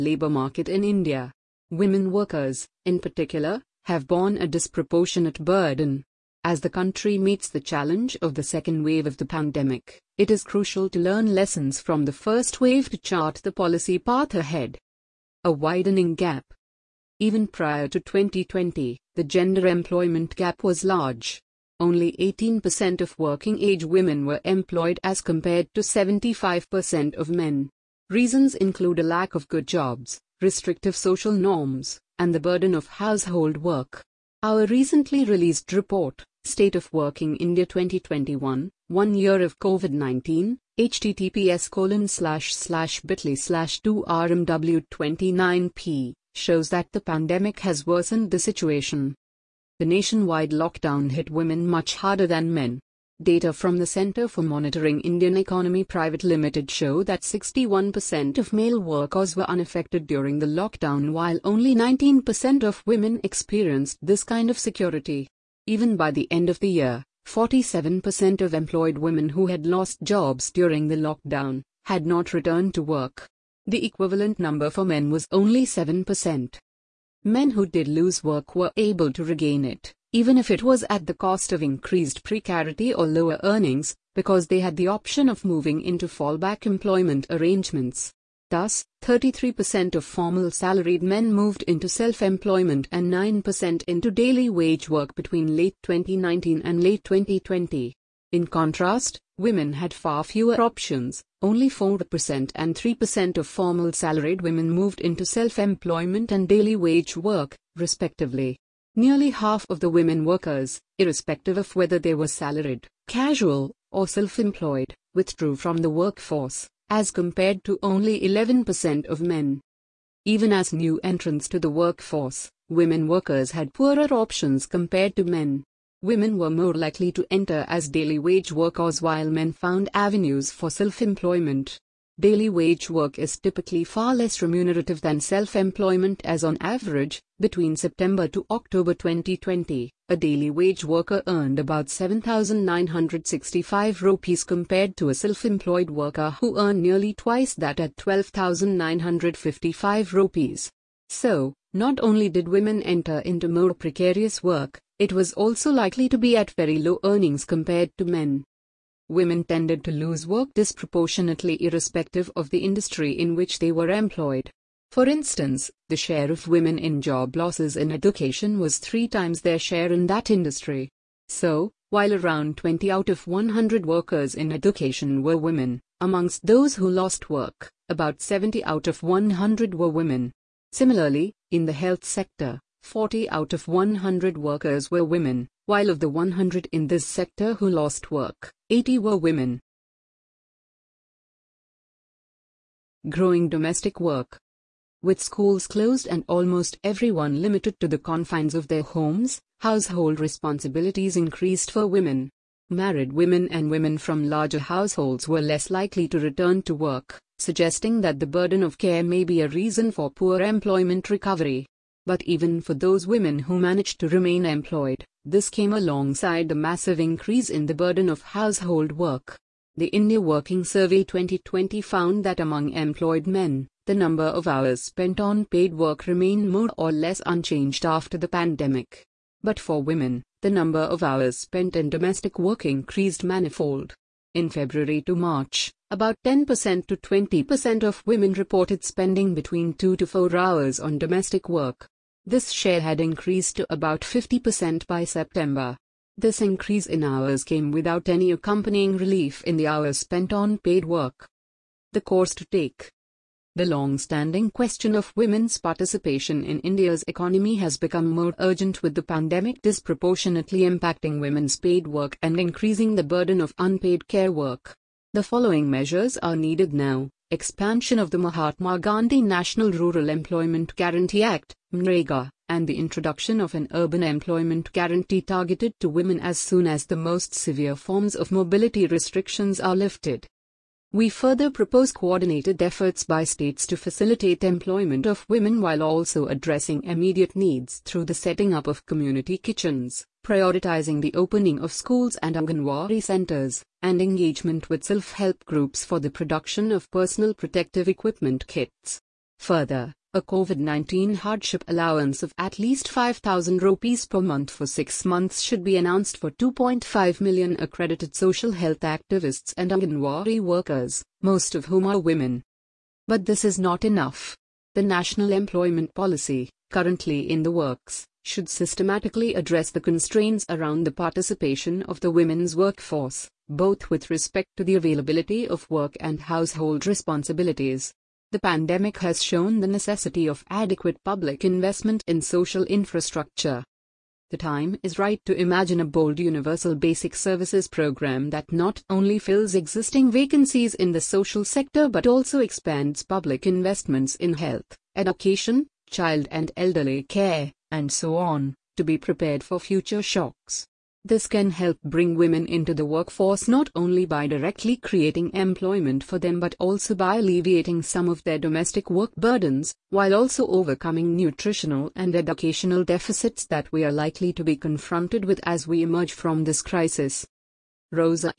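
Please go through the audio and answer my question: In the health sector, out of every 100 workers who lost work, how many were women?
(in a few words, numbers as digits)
80.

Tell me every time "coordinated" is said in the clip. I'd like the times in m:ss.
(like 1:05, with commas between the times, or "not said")
4:41.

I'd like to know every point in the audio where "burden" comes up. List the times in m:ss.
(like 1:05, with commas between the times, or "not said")
0:05, 0:32, 3:28, 3:37, 4:23, 5:59.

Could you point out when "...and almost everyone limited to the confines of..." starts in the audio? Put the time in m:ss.
3:16.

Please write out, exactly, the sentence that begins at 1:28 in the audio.
Thus, 33% of formal salaried men moved into self employment and 9% into daily wage work between late 2019 and late 2020.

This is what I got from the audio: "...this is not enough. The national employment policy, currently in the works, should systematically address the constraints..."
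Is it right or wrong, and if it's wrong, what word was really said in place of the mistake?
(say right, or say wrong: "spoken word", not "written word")
right.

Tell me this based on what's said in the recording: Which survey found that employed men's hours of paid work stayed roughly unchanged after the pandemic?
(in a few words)
India Working Survey 2020.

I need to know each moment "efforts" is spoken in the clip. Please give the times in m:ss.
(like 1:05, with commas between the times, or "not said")
4:42.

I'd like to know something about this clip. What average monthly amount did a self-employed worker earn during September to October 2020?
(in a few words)
12,955 rupees.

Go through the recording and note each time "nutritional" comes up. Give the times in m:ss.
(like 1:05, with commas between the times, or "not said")
6:01.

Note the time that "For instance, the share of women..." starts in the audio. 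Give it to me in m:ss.
2:44.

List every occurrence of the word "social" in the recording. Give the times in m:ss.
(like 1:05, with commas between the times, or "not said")
0:30, 5:08, 5:32, 5:41.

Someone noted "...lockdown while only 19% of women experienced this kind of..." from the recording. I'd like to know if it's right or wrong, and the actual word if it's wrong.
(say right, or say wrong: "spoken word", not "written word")
right.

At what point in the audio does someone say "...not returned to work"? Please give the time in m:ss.
1:12.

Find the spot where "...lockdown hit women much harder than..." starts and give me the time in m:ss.
0:50.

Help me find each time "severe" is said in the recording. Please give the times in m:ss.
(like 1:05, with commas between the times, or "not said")
4:37.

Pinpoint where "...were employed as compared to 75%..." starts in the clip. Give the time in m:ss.
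0:24.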